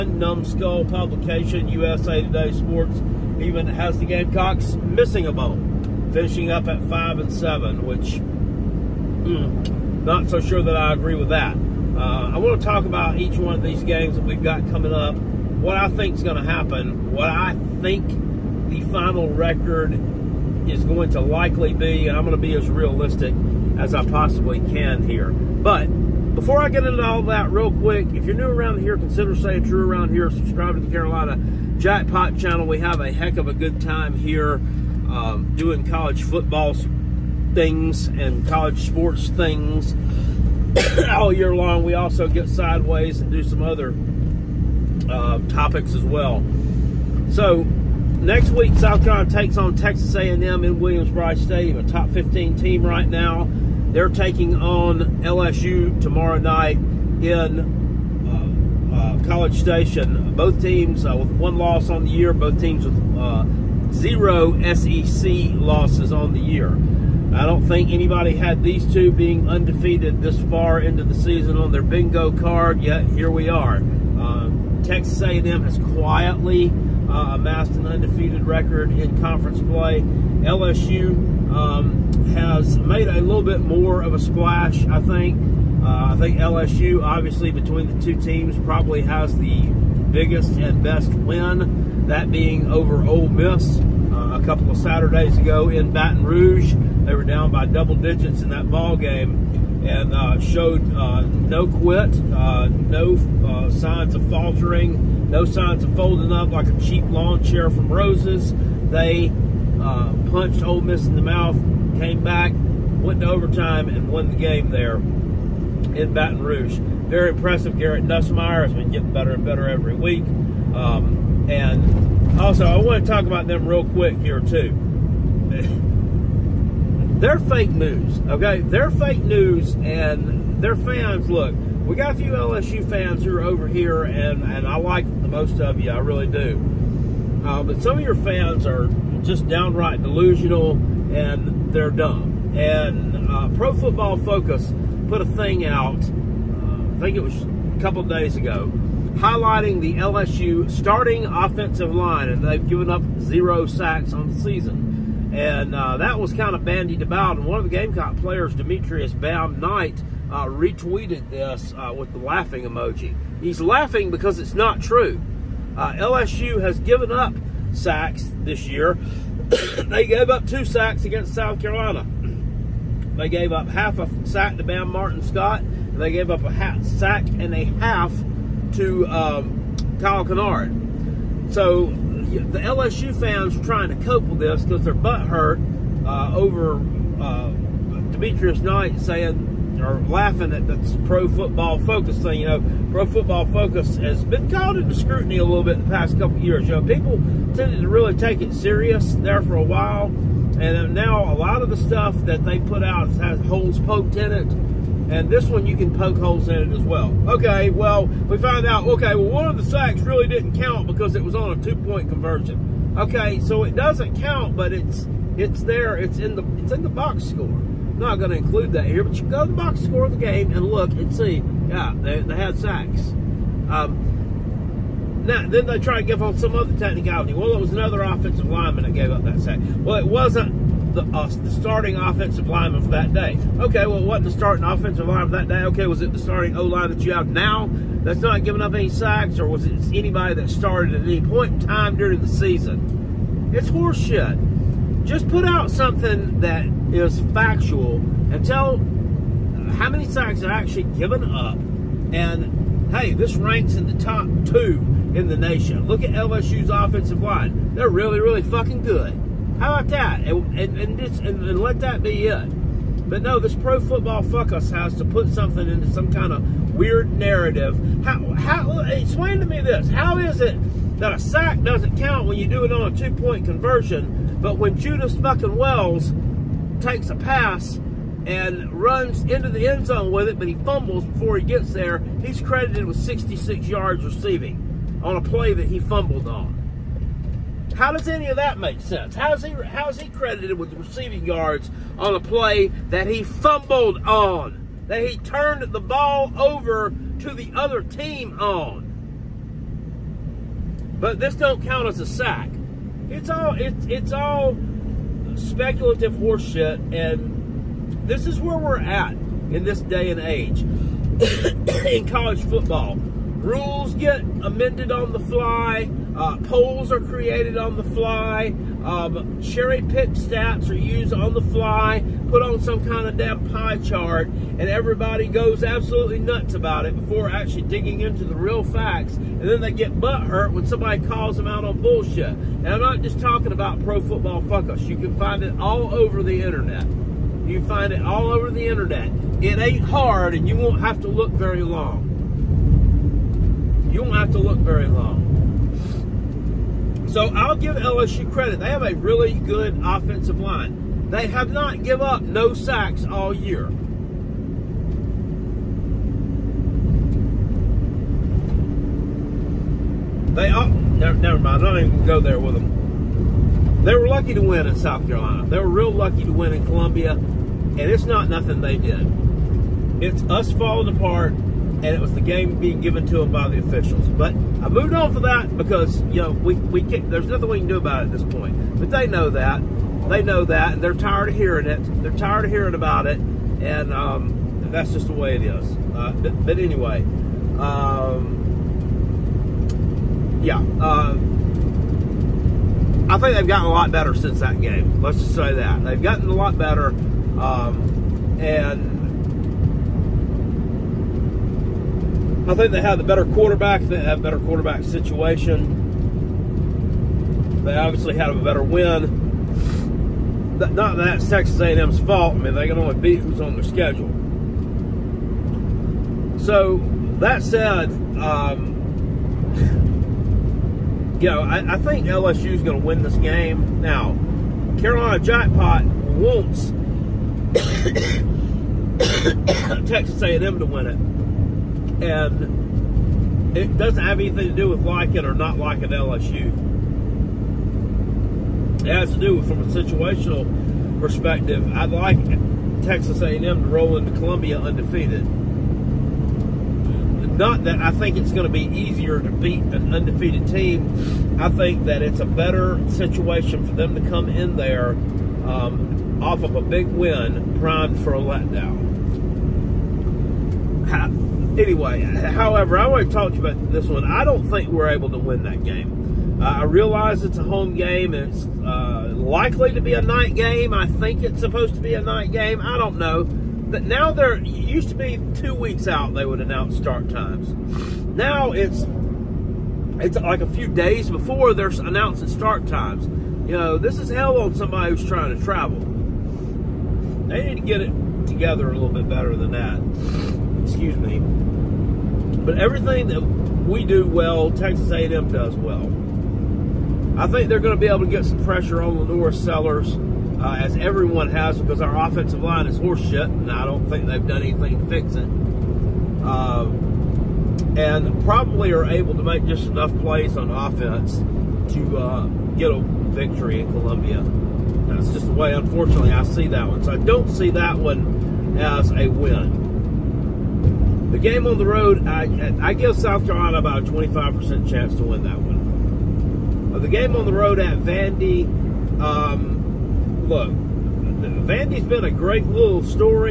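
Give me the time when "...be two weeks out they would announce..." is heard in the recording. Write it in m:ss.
7:54.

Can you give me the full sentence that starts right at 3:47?
Well, it was another offensive lineman that gave up that sack.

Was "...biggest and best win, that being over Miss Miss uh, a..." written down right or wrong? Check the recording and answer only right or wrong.
wrong.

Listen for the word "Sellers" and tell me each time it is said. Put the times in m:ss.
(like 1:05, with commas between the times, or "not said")
8:19.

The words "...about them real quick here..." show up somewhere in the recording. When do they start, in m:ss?
2:03.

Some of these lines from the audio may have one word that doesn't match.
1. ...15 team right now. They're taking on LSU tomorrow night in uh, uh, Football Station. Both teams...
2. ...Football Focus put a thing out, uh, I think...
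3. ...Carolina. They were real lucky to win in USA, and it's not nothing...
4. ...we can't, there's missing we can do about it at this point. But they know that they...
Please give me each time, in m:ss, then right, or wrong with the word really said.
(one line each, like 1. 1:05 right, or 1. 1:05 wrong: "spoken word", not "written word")
1. 0:52 wrong: "College", not "Football"
2. 2:23 right
3. 6:05 wrong: "Columbia", not "USA"
4. 6:16 wrong: "nothing", not "missing".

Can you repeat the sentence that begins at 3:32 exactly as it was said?
Okay, so it doesn't count, but it's it's there, it's in the it's in the box score.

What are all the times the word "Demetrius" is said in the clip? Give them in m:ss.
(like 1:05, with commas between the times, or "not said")
2:38, 3:08.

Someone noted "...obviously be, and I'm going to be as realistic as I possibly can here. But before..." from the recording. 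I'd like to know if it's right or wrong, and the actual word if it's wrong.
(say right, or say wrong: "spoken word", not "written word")
wrong: "likely", not "obviously".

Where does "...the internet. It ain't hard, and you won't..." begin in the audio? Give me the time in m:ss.
5:38.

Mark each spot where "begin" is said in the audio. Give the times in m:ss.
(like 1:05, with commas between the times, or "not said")
not said.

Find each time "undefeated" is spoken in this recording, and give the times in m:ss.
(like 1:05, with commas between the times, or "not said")
1:09, 1:17, 7:24, 7:29.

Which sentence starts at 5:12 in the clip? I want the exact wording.
Rules get amended on the fly uh, polls are created on the fly.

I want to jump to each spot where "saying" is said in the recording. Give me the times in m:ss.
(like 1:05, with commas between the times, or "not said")
0:29, 3:08.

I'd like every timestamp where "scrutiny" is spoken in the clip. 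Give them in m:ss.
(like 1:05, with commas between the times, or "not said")
3:14.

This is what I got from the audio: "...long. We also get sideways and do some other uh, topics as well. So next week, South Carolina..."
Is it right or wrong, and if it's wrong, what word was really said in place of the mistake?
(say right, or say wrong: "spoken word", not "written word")
right.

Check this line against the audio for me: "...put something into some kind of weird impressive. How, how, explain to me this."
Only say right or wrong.
wrong.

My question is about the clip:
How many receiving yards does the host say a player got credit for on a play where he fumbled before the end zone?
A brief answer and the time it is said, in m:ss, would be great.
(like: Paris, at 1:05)
66, at 4:42.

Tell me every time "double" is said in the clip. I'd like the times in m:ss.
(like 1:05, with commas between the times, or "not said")
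1:37.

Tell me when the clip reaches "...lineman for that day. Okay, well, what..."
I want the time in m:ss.
3:52.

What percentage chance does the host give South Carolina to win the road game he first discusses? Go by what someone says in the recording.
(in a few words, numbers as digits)
25%.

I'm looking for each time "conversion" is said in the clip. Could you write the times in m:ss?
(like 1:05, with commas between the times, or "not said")
3:32, 4:33.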